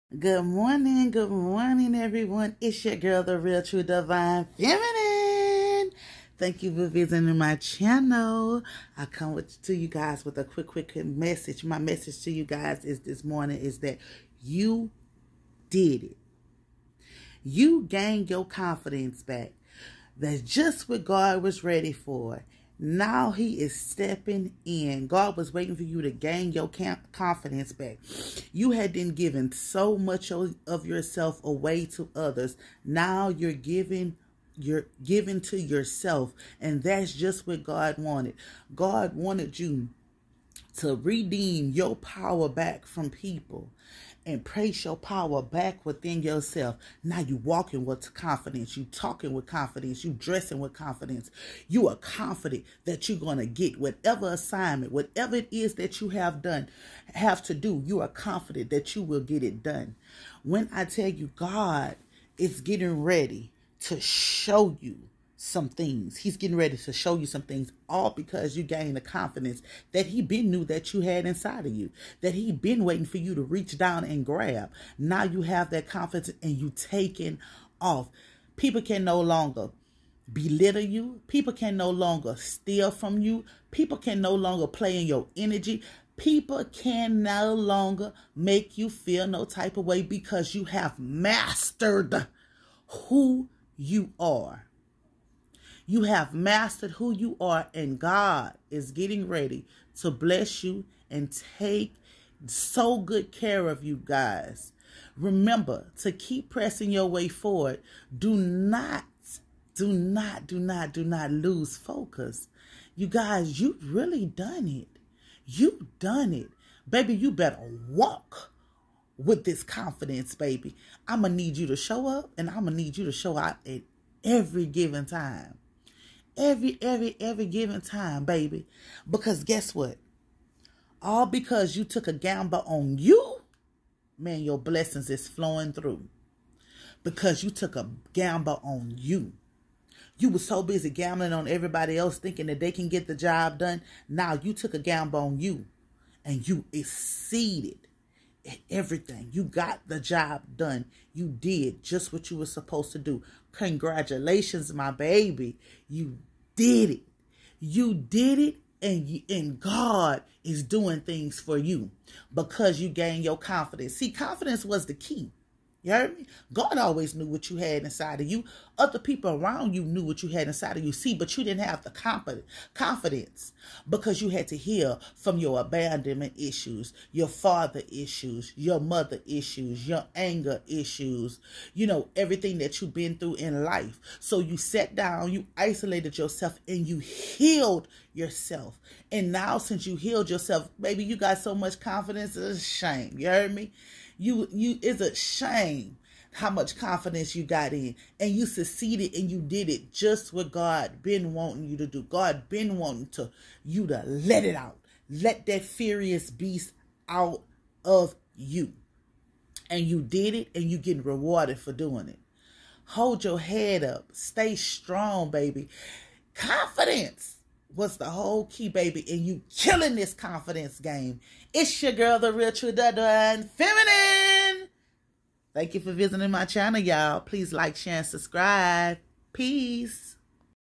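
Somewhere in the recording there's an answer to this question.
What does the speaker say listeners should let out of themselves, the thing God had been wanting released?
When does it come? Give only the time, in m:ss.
3:25.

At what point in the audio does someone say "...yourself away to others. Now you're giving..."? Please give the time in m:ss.
0:30.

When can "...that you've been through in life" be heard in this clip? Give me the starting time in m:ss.
3:02.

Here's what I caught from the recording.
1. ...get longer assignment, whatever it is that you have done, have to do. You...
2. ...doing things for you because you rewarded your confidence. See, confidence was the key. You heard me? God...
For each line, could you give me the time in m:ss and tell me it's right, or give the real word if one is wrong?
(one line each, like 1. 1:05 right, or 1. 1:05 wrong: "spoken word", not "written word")
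1. 0:53 wrong: "whatever", not "longer"
2. 2:40 wrong: "gained", not "rewarded".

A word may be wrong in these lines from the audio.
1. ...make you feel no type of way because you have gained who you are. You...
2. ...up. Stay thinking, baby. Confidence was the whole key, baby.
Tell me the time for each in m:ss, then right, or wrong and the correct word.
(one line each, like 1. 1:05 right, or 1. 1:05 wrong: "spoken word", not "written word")
1. 1:28 wrong: "mastered", not "gained"
2. 3:33 wrong: "strong", not "thinking".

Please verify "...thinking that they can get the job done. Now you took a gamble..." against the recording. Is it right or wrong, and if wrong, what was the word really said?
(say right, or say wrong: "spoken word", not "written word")
right.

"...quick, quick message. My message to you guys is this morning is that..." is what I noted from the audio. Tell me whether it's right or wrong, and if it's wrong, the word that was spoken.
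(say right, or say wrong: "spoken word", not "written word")
right.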